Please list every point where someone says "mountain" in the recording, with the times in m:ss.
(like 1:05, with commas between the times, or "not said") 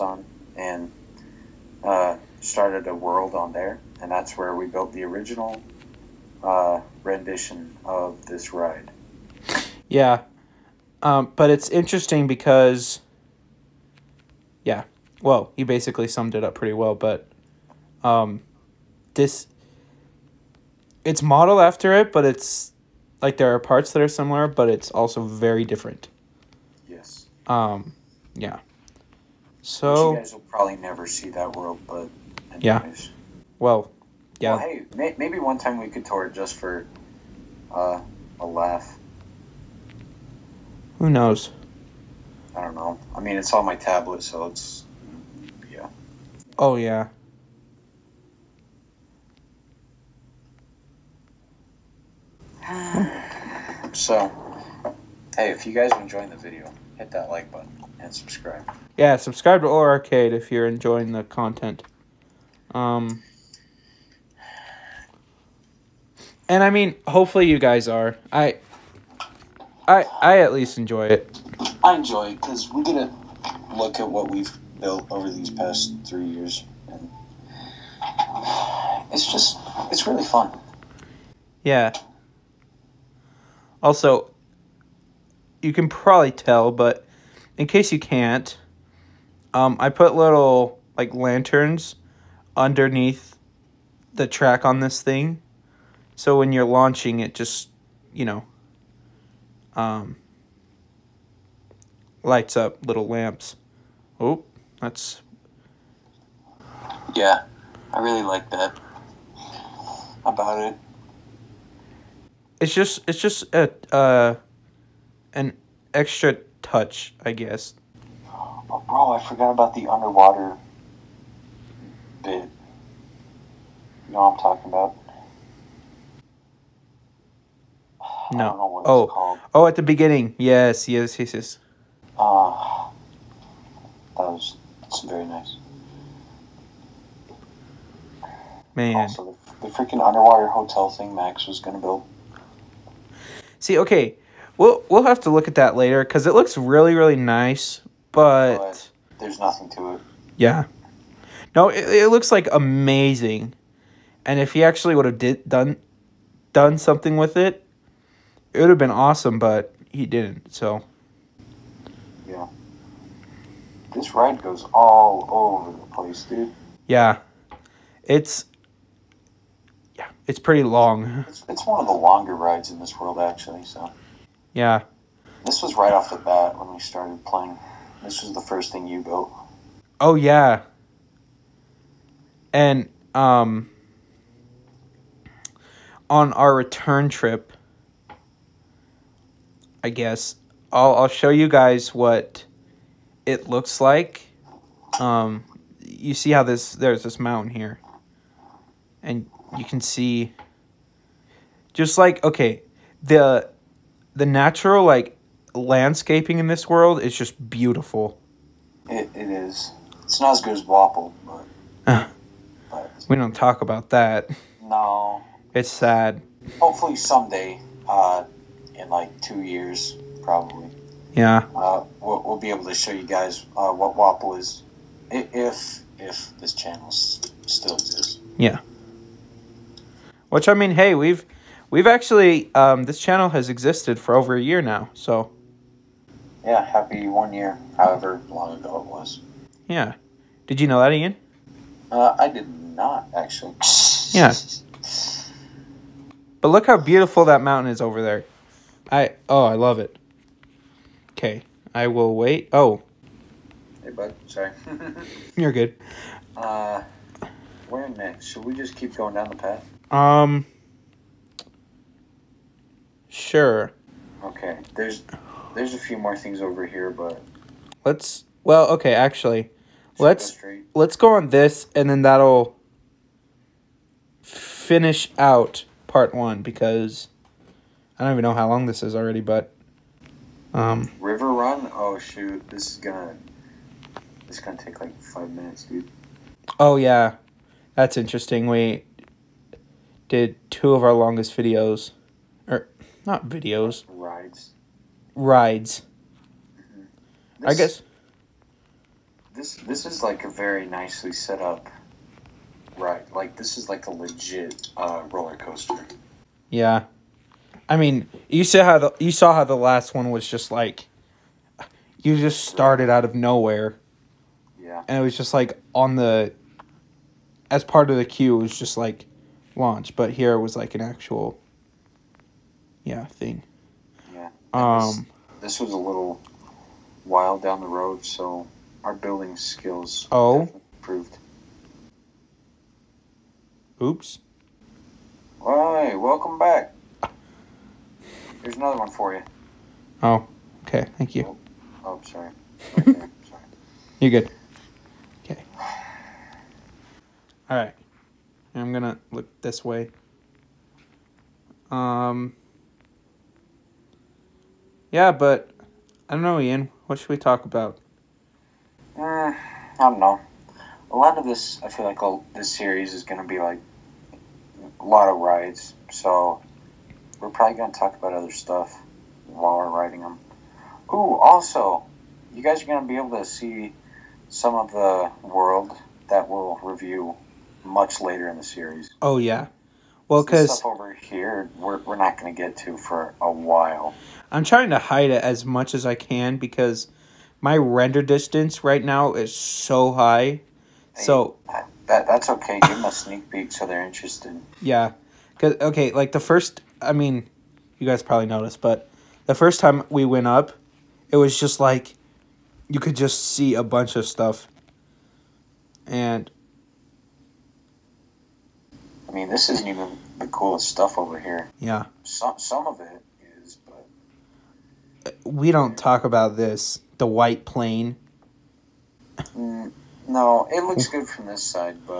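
3:17, 4:07.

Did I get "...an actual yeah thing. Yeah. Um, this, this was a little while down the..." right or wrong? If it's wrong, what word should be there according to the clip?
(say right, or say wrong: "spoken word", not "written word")
right.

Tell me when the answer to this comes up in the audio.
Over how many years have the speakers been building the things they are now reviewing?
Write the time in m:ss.
1:16.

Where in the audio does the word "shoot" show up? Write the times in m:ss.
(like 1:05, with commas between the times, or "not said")
4:41.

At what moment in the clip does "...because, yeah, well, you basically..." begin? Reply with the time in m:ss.
0:12.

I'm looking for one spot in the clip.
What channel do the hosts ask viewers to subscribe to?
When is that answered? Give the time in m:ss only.
0:59.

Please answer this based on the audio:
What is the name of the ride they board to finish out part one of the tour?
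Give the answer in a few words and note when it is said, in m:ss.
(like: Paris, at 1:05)
River Run, at 4:41.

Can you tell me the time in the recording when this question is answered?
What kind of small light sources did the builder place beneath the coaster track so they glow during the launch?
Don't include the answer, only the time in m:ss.
1:31.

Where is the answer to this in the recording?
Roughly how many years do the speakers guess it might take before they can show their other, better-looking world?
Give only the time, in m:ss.
3:39.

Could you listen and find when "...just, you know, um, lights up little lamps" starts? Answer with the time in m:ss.
1:37.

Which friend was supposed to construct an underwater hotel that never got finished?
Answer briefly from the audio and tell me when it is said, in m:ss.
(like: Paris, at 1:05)
Max, at 2:21.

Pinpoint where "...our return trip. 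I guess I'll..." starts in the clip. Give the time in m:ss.
3:06.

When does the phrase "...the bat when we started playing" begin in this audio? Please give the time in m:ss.
2:56.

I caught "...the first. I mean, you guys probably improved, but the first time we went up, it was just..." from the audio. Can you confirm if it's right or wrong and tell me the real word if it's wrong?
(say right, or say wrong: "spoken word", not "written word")
wrong: "noticed", not "improved".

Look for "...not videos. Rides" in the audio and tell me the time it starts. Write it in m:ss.
4:53.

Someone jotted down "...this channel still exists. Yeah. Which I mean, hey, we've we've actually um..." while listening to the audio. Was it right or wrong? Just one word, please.
right.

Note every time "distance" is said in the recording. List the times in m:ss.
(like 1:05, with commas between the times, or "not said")
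6:28.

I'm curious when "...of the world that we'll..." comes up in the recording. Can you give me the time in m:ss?
6:14.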